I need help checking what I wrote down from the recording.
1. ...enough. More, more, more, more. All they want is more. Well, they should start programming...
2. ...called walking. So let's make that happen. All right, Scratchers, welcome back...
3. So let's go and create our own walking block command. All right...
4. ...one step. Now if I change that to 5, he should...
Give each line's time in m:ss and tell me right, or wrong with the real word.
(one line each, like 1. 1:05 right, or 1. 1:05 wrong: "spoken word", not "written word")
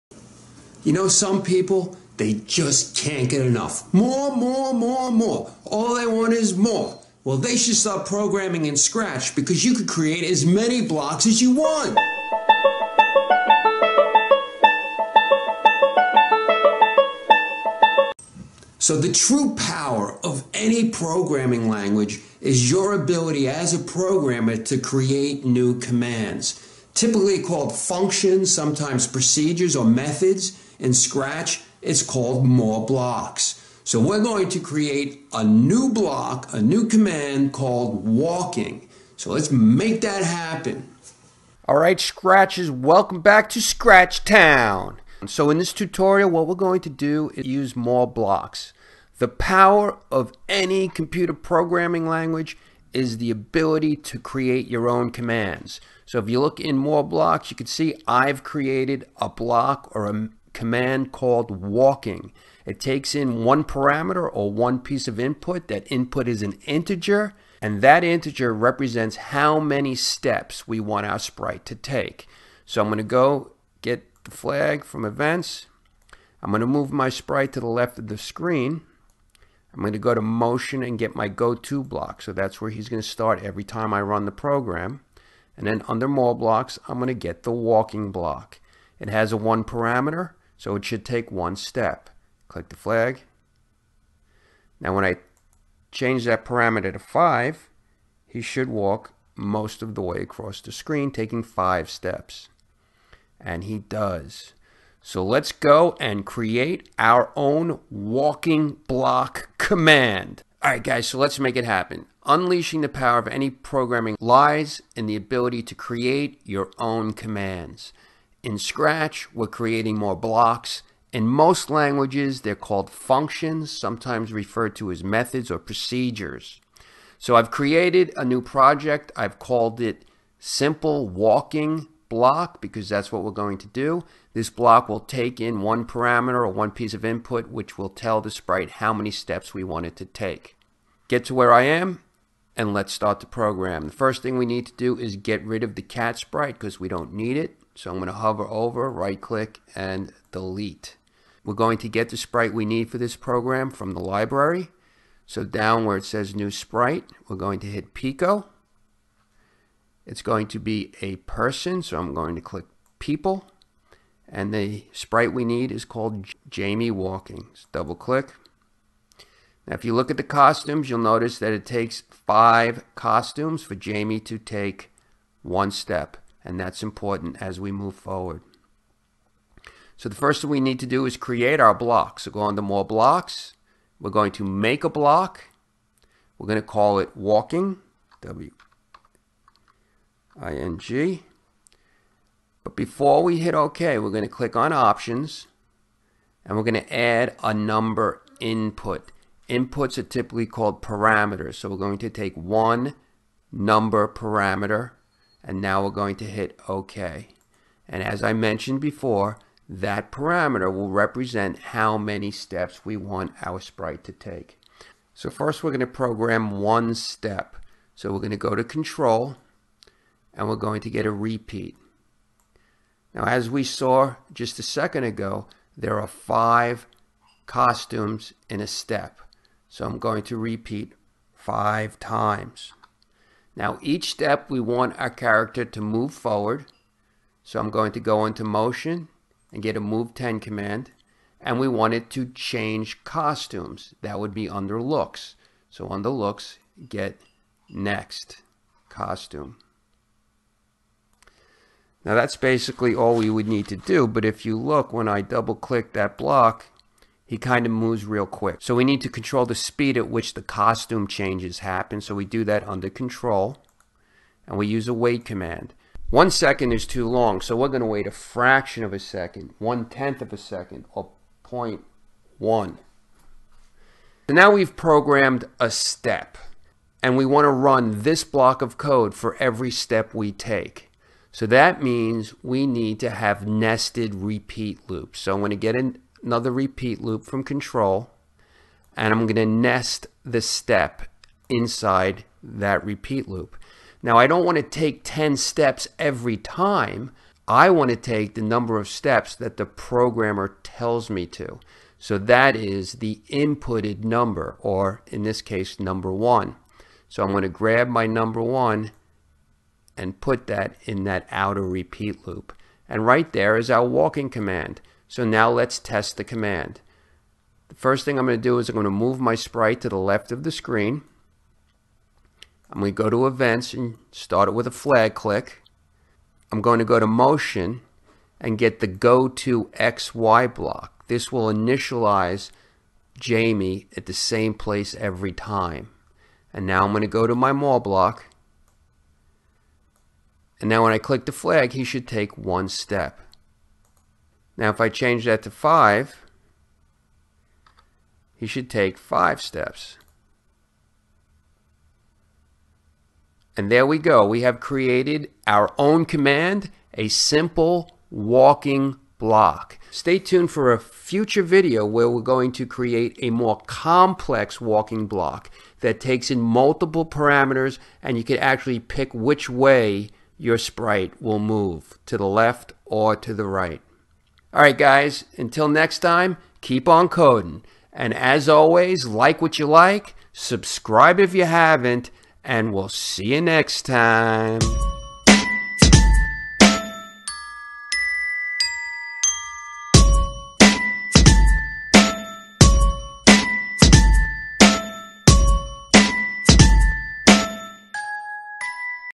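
1. 0:03 right
2. 0:37 right
3. 1:45 right
4. 5:42 right.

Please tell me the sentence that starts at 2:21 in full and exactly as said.
Get to where I am, and let's start the program.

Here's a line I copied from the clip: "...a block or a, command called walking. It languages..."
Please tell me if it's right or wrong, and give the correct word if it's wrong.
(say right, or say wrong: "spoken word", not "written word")
wrong: "takes", not "languages".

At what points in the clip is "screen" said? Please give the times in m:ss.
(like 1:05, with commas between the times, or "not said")
1:18, 1:40, 5:20.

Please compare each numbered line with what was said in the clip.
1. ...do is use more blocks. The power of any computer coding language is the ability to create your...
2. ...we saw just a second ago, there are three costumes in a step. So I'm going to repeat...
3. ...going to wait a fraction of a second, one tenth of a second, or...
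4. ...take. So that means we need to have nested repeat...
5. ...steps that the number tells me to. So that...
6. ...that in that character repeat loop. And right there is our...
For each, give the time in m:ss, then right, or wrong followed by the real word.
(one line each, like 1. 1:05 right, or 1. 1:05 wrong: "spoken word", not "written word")
1. 0:46 wrong: "programming", not "coding"
2. 3:43 wrong: "five", not "three"
3. 4:27 right
4. 4:40 right
5. 4:58 wrong: "programmer", not "number"
6. 5:10 wrong: "outer", not "character".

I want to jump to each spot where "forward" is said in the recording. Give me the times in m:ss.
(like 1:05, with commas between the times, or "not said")
2:57, 3:56.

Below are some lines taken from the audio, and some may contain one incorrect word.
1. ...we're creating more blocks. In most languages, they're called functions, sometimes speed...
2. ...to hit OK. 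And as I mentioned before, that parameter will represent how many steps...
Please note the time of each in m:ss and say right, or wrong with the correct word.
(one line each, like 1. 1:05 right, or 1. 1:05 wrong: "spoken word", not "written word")
1. 1:59 wrong: "referred", not "speed"
2. 3:26 right.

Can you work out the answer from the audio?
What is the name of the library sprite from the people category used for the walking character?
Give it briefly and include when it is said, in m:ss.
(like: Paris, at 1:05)
Jamie Walkings, at 2:46.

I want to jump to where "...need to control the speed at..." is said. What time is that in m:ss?
4:18.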